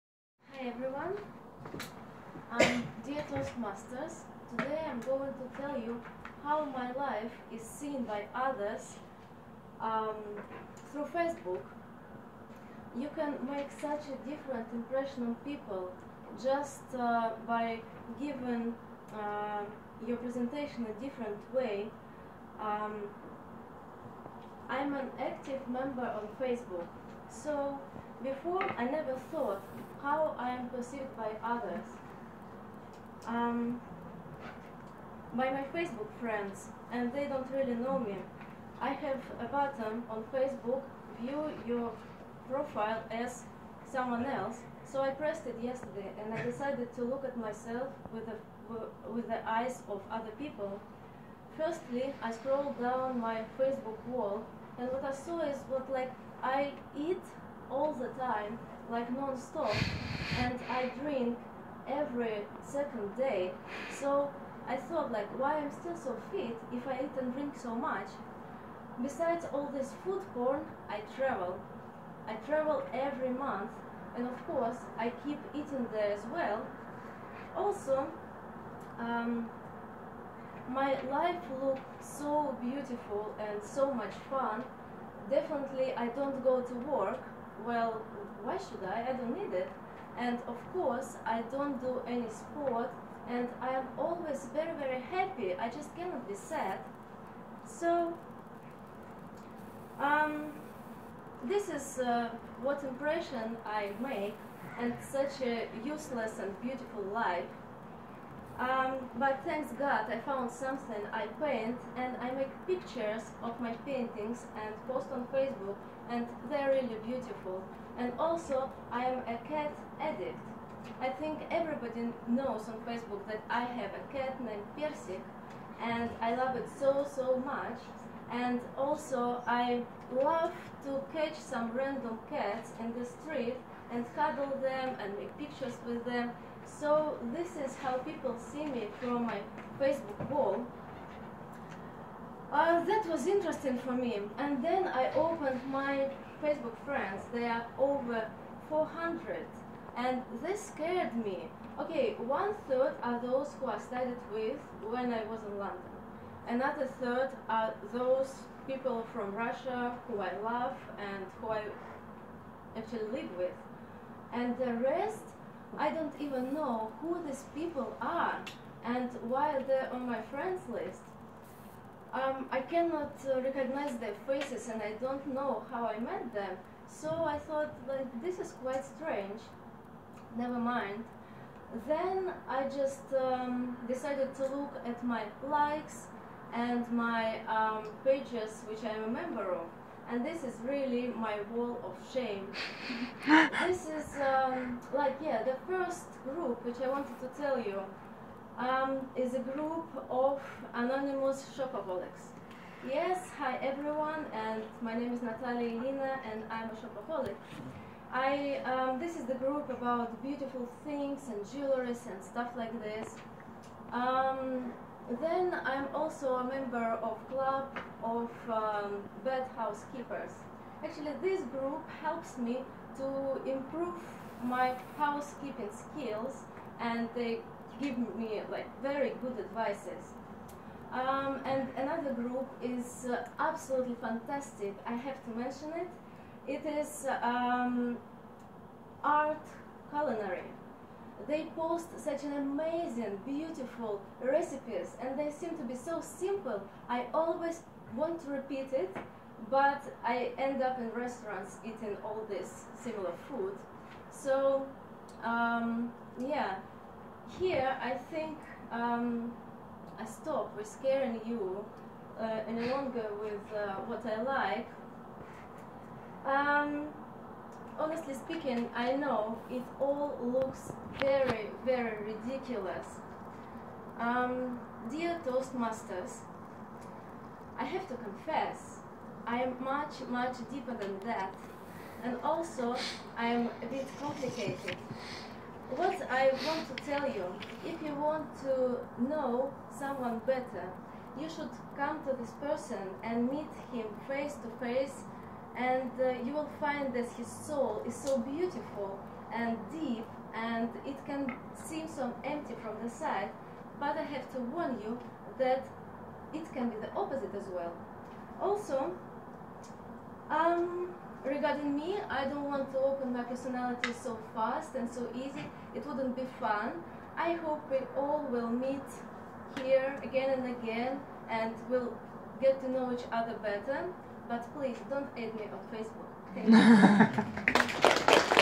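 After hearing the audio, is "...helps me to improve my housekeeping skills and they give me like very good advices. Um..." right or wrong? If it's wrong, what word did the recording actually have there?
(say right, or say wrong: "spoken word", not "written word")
right.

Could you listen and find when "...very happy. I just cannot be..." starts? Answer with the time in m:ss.
1:34.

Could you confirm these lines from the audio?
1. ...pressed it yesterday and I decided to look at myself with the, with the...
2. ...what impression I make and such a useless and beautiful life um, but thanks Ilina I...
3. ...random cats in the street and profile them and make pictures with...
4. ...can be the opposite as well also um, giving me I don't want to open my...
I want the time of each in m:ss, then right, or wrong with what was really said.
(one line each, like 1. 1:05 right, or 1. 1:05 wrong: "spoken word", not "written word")
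1. 0:45 right
2. 1:42 wrong: "God", not "Ilina"
3. 2:11 wrong: "cuddle", not "profile"
4. 5:06 wrong: "regarding", not "giving".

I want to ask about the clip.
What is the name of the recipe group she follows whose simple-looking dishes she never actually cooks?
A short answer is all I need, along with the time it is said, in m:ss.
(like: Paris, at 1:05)
art culinary, at 3:59.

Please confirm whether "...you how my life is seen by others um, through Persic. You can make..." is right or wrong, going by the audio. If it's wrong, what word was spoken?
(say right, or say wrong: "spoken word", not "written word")
wrong: "Facebook", not "Persic".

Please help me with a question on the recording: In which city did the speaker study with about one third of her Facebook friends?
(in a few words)
London.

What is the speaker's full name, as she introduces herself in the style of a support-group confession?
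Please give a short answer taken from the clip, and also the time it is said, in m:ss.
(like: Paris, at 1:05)
Natalia Ilina, at 3:25.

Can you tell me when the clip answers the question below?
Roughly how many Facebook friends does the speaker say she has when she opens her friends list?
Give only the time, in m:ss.
2:27.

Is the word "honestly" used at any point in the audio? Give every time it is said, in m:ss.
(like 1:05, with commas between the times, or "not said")
4:27.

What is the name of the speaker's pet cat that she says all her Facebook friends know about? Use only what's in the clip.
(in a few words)
Persic.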